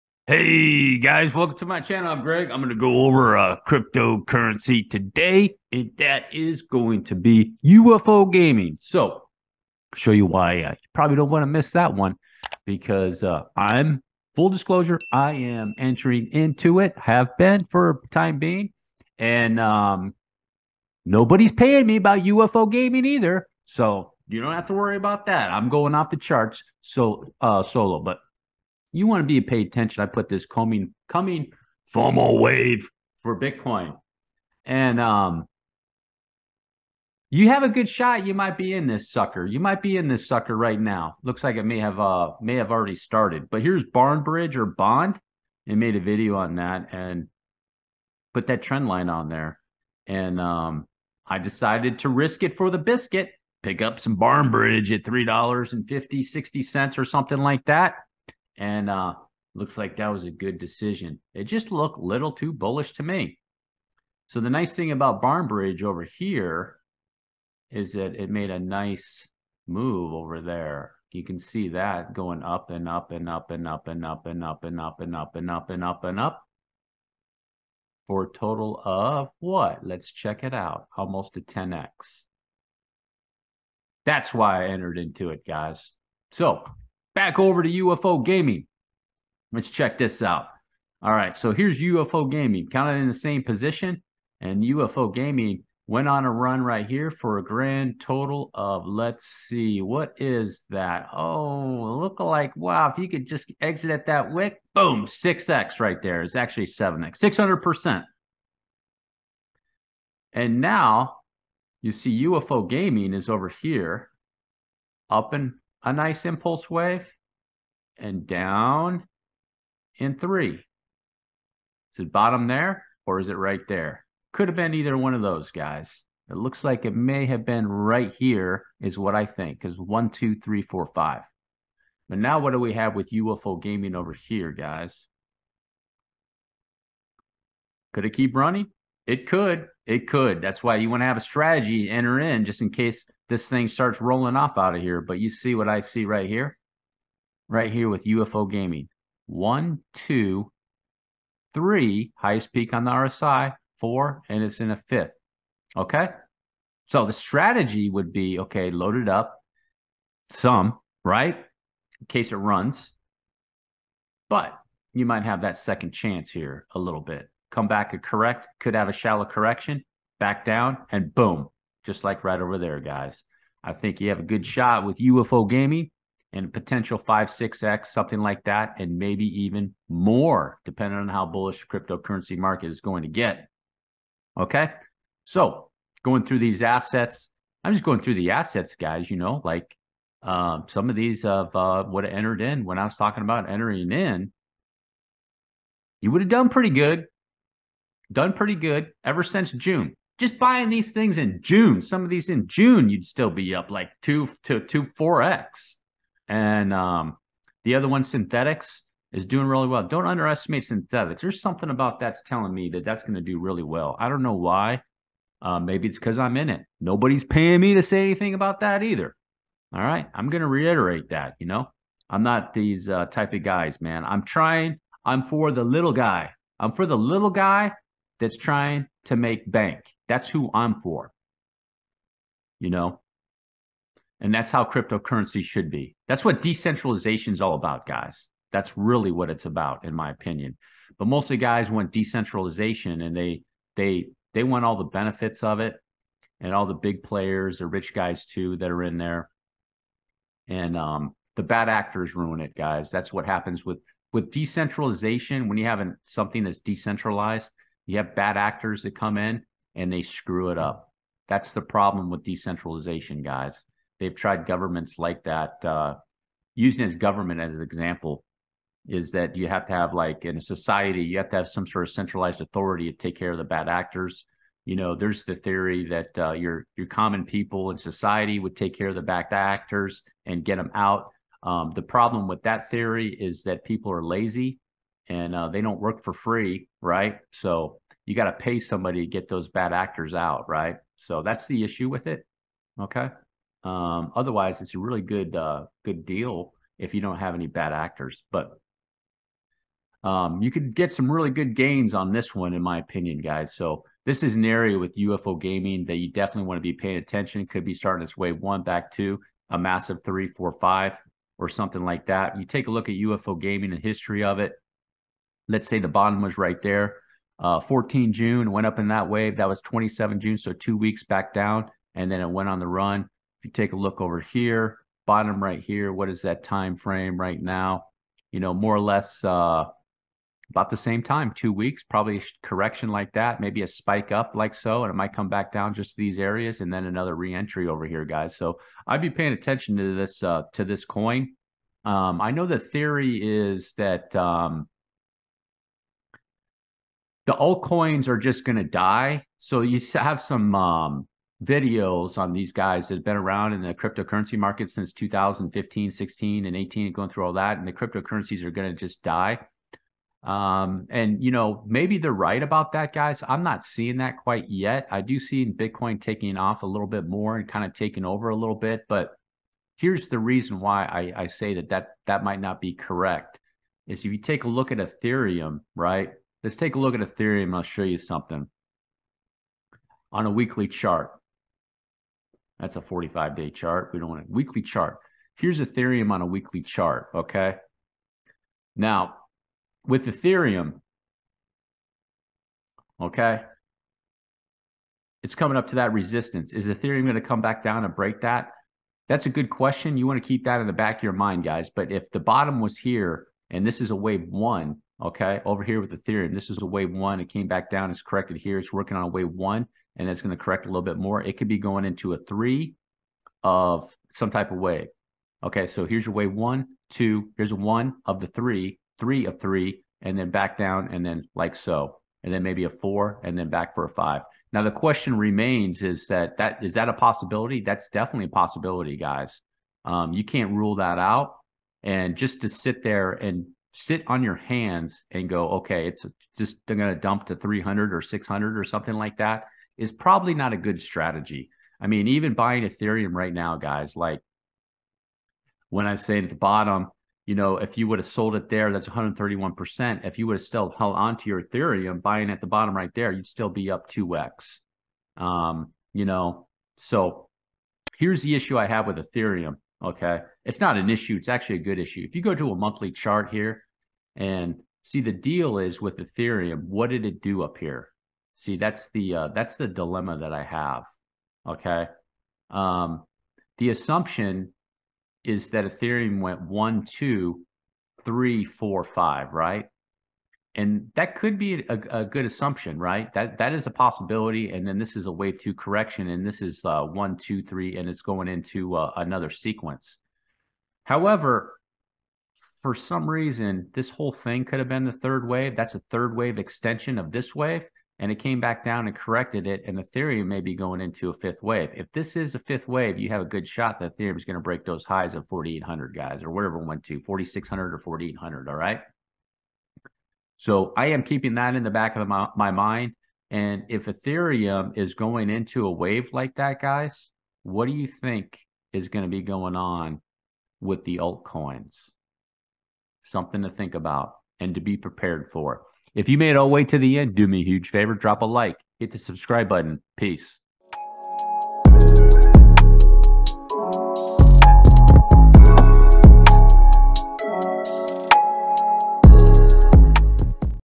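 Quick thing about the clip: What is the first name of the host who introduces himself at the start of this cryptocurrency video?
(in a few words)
Greg.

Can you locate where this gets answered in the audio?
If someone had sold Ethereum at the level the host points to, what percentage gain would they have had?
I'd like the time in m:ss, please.
7:28.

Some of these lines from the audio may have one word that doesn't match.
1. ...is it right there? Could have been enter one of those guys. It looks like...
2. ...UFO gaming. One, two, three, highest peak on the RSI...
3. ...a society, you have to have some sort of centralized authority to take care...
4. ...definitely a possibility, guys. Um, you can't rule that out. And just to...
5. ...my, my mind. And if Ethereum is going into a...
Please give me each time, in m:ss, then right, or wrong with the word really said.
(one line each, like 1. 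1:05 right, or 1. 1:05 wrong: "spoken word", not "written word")
1. 2:03 wrong: "either", not "enter"
2. 2:28 right
3. 4:30 right
4. 7:07 right
5. 8:32 right.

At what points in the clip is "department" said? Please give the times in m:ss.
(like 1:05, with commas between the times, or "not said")
not said.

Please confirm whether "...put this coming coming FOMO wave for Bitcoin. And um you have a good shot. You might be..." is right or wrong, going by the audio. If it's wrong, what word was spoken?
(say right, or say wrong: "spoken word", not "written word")
right.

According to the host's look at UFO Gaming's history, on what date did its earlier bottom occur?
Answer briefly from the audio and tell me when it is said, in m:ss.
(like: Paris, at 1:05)
14 June, at 5:17.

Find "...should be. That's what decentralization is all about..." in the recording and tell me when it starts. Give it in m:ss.
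3:55.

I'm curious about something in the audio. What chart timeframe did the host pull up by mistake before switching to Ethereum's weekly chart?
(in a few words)
45 day.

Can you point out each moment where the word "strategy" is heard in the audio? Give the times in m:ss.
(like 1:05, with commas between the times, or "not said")
2:21, 2:37, 7:20.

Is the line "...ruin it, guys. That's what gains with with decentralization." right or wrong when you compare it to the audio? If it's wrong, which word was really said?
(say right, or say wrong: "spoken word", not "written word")
wrong: "happens", not "gains".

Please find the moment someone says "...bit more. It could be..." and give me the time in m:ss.
6:50.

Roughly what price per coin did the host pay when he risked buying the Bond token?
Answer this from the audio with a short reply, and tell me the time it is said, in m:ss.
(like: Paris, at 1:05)
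$3.50, at 0:55.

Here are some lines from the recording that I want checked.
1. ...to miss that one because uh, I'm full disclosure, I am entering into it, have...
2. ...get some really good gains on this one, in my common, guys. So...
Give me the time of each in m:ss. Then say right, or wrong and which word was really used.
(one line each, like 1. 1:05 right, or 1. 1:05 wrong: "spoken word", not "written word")
1. 0:11 right
2. 5:00 wrong: "opinion", not "common".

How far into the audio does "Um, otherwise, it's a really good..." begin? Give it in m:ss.
4:53.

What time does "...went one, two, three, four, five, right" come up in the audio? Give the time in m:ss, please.
7:56.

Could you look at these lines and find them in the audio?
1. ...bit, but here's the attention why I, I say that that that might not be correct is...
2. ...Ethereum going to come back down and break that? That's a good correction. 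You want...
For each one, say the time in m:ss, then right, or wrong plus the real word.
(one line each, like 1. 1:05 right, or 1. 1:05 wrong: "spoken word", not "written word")
1. 6:08 wrong: "reason", not "attention"
2. 6:36 wrong: "question", not "correction".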